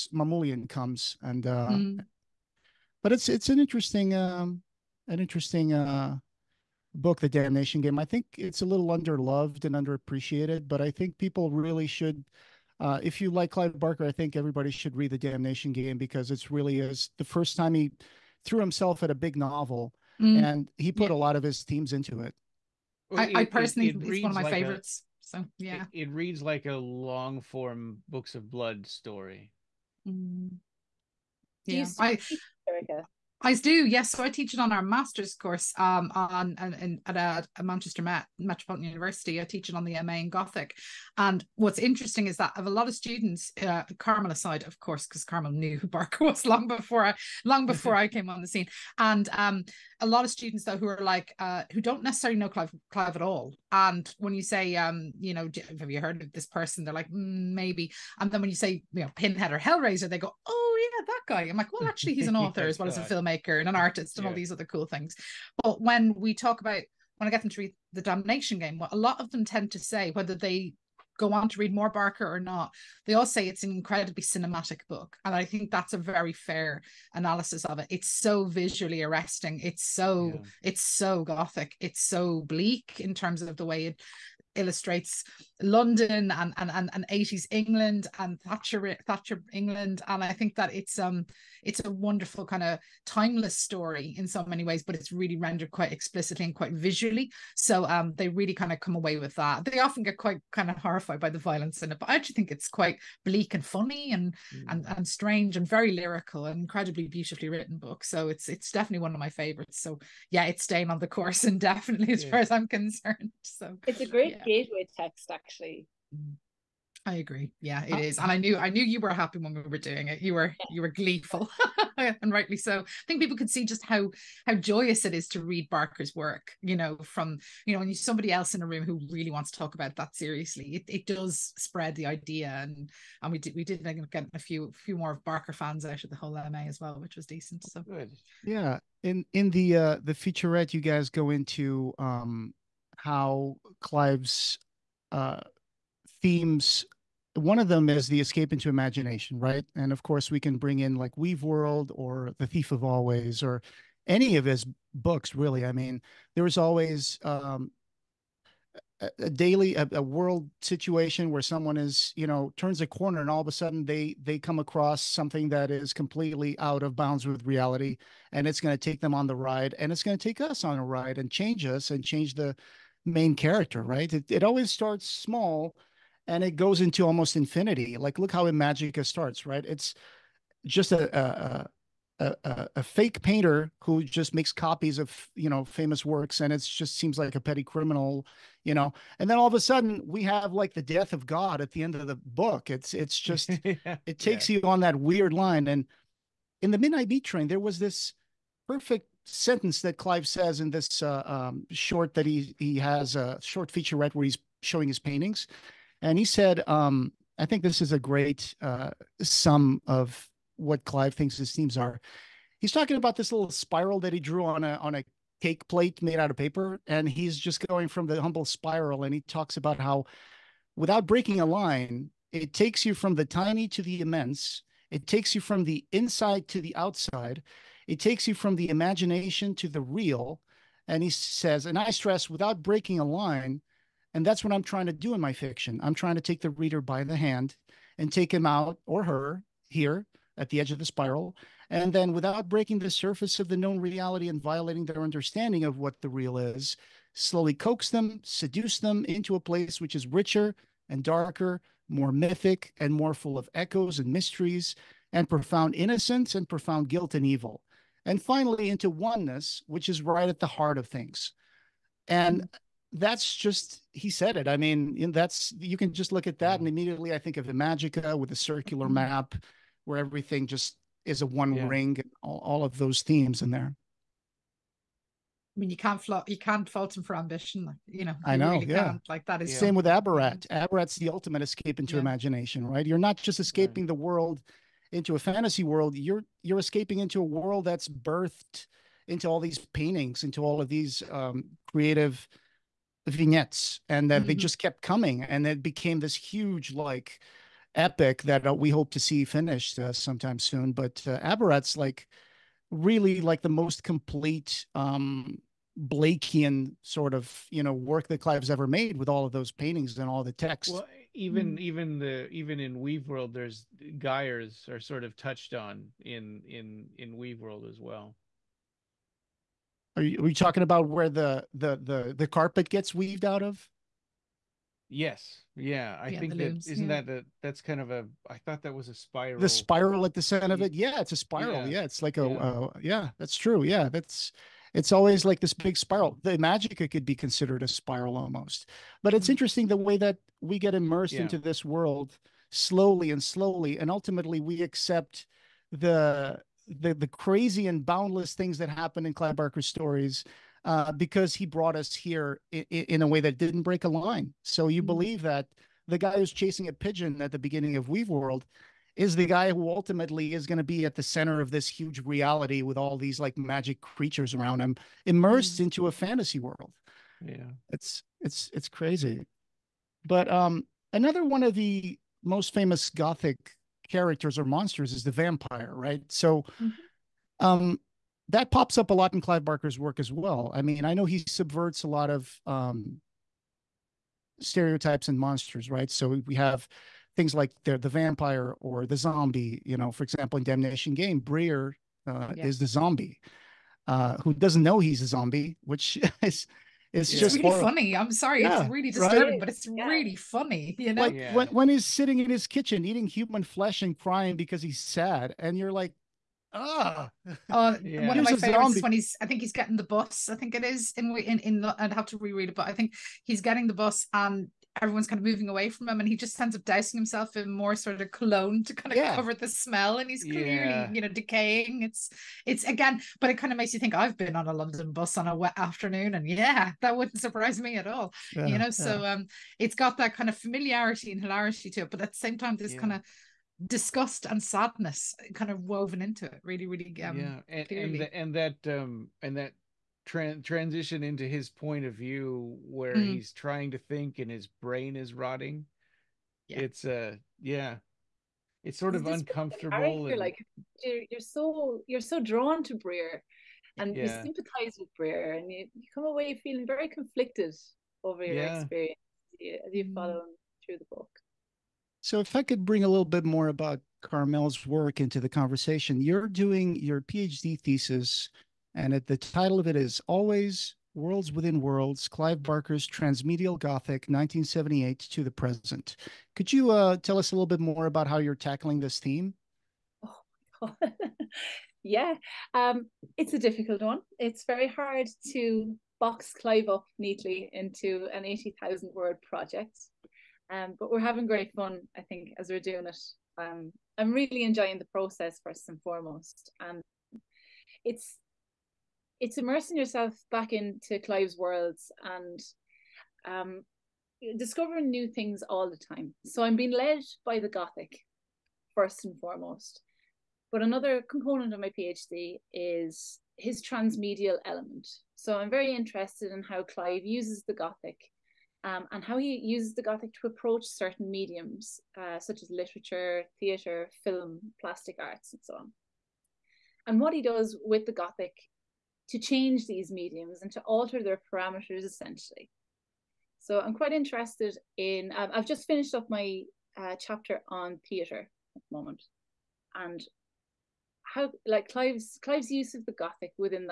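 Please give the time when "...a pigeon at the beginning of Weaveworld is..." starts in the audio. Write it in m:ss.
5:56.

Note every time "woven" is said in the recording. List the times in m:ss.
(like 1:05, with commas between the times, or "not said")
7:15.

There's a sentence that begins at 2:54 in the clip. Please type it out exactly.
It, it always starts small and it goes into almost infinity.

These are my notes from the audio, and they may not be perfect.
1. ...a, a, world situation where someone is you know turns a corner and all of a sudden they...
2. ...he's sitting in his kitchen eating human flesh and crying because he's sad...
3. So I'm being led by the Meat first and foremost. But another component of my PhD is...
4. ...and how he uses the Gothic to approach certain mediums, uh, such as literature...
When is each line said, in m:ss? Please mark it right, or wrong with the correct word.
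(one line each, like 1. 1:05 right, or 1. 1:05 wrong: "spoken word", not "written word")
1. 2:39 right
2. 6:41 right
3. 8:26 wrong: "Gothic", not "Meat"
4. 8:38 right.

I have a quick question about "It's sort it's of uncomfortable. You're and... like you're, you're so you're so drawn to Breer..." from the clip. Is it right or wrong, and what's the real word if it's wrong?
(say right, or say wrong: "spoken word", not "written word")
right.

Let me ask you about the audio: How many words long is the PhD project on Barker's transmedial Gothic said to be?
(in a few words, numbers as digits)
80,000.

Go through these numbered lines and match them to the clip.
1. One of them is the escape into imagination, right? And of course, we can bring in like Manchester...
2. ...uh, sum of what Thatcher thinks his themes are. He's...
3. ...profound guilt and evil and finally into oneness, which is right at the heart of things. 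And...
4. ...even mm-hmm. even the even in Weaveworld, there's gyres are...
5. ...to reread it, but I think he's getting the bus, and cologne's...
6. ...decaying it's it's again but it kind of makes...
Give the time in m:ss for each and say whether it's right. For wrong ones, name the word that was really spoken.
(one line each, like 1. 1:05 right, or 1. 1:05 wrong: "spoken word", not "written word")
1. 2:27 wrong: "Weaveworld", not "Manchester"
2. 3:28 wrong: "Clive", not "Thatcher"
3. 4:16 right
4. 5:11 right
5. 6:52 wrong: "everyone", not "cologne"
6. 7:01 right.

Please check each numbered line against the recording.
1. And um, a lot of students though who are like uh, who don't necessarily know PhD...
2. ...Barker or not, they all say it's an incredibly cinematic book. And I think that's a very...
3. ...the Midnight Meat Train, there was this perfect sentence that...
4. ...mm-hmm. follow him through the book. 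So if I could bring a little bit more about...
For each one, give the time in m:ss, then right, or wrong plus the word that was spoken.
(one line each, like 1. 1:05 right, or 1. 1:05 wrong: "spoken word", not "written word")
1. 0:48 wrong: "Clive", not "PhD"
2. 1:11 right
3. 3:16 right
4. 7:39 right.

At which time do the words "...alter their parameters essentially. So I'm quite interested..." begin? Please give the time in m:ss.
8:50.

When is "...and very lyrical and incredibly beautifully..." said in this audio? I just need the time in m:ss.
1:45.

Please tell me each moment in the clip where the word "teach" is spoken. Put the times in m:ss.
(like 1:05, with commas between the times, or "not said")
0:34, 0:39.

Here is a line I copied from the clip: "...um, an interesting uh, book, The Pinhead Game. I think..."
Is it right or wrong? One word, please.
wrong.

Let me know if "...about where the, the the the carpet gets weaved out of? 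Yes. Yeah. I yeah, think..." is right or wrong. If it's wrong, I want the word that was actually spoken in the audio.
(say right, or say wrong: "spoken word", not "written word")
right.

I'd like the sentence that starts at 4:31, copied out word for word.
ring and all, all of those themes in there.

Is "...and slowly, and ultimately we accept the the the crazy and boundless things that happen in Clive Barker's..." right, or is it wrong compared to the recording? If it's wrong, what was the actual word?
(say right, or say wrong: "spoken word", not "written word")
right.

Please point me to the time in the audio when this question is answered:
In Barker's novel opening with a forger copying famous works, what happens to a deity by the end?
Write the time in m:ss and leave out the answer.
3:10.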